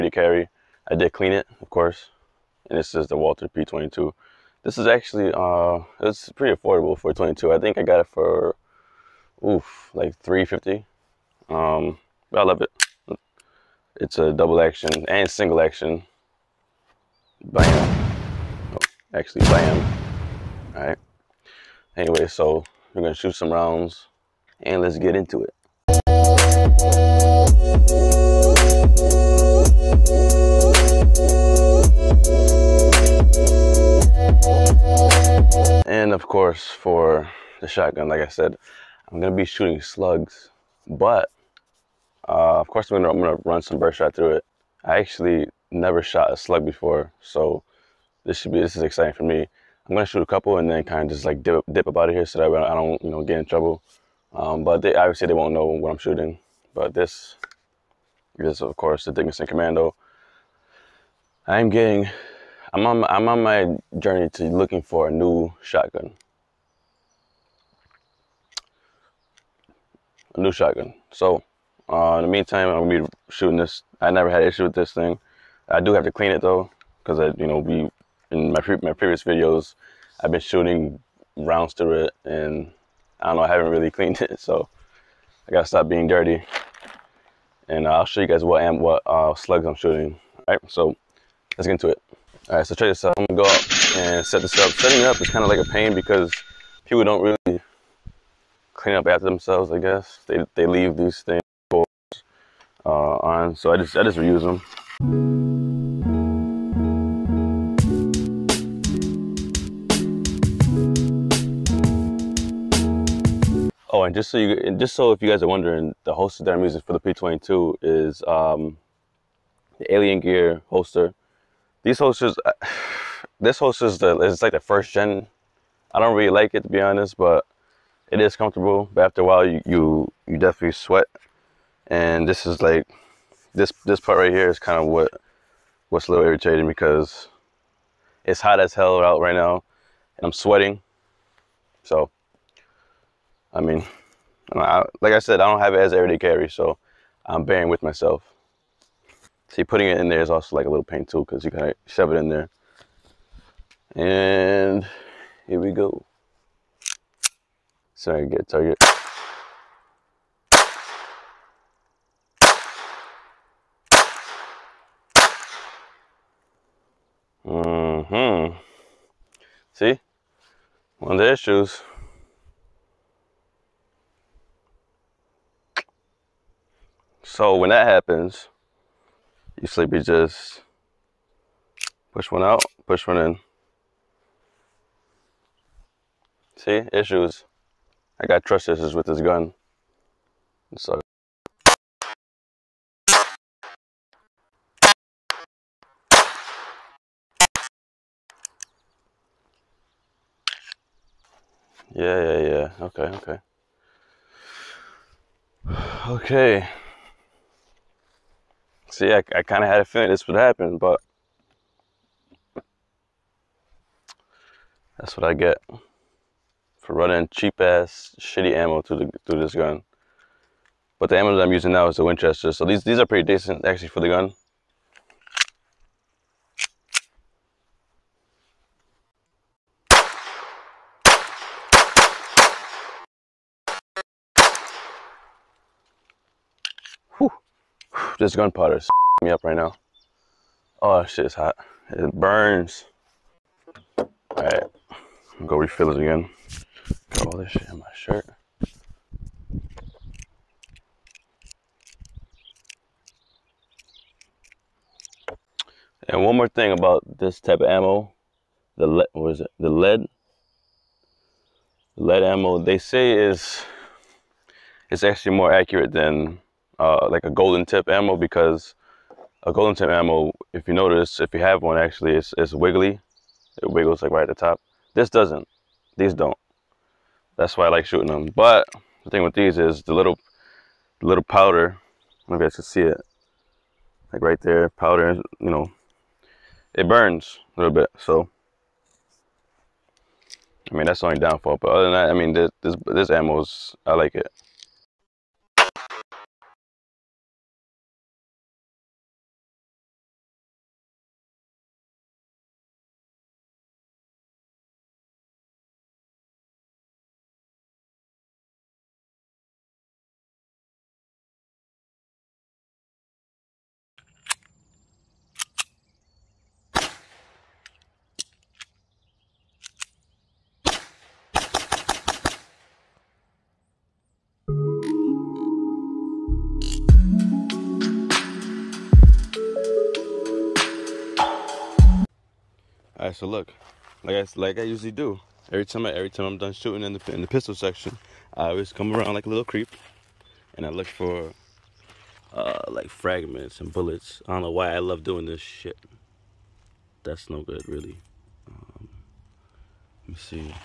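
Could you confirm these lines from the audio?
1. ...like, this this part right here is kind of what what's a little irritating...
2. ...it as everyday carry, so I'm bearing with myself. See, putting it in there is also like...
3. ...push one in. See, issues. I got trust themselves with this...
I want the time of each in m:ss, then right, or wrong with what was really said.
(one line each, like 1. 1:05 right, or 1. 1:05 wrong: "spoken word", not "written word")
1. 2:12 right
2. 2:25 right
3. 3:02 wrong: "issues", not "themselves".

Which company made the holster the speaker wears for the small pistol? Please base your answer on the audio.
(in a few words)
Alien Gear.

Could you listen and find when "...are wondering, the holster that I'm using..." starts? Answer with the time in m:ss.
1:55.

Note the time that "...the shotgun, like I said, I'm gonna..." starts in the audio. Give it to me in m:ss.
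0:37.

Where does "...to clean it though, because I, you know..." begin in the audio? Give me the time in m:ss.
1:16.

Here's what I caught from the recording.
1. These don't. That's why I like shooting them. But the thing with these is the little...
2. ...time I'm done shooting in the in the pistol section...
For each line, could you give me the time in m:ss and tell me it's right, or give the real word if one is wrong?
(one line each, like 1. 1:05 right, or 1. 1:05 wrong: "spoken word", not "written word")
1. 4:35 right
2. 5:36 right.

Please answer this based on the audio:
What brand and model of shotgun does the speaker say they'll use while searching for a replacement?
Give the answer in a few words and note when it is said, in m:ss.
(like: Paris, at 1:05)
Dickinson Commando, at 0:59.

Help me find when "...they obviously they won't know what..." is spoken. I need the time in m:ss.
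0:54.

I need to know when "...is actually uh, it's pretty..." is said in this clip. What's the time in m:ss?
0:04.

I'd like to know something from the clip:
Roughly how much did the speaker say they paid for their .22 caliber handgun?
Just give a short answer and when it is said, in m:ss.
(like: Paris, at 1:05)
$350, at 0:10.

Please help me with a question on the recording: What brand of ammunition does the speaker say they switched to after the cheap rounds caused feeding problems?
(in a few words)
Winchester.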